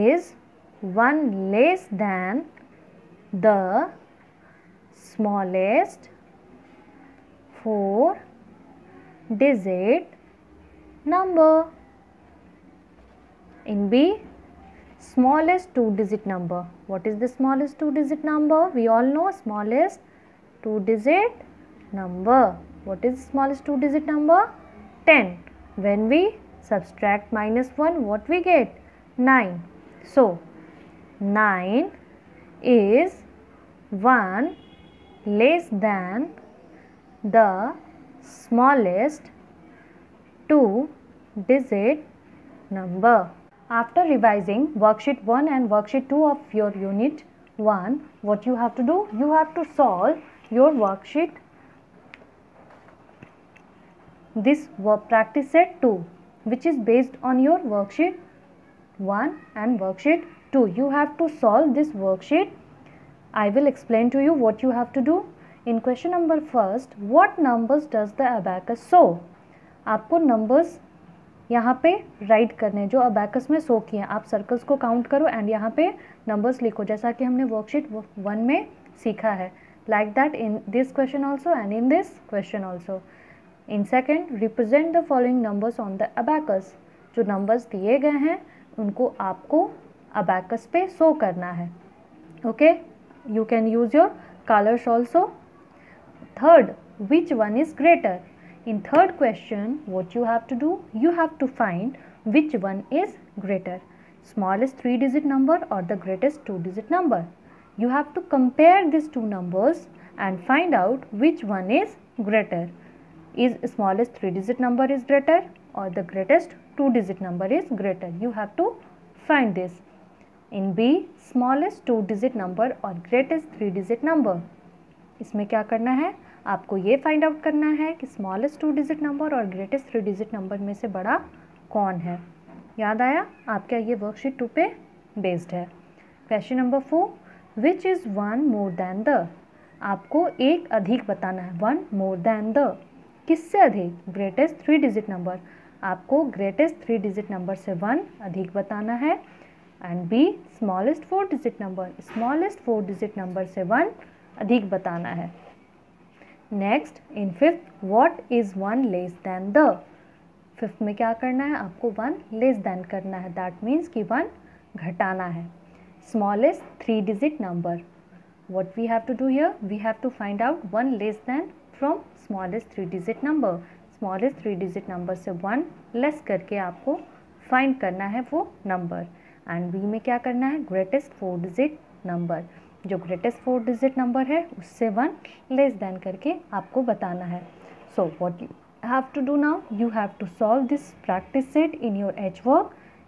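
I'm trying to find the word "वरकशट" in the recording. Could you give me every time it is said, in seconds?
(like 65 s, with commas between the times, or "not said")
77 s, 134 s.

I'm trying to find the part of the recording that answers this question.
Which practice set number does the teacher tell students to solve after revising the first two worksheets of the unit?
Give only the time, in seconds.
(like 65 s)
55 s.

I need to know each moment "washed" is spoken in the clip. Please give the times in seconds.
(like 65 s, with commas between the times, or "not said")
not said.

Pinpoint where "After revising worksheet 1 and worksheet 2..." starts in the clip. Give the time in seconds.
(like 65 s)
43 s.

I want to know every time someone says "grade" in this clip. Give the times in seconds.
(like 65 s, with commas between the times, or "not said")
not said.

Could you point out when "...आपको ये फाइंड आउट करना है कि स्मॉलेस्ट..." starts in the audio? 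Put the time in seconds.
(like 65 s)
126 s.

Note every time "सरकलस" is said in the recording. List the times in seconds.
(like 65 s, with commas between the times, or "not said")
74 s.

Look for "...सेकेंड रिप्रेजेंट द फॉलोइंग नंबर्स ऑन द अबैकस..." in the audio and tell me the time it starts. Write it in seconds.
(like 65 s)
83 s.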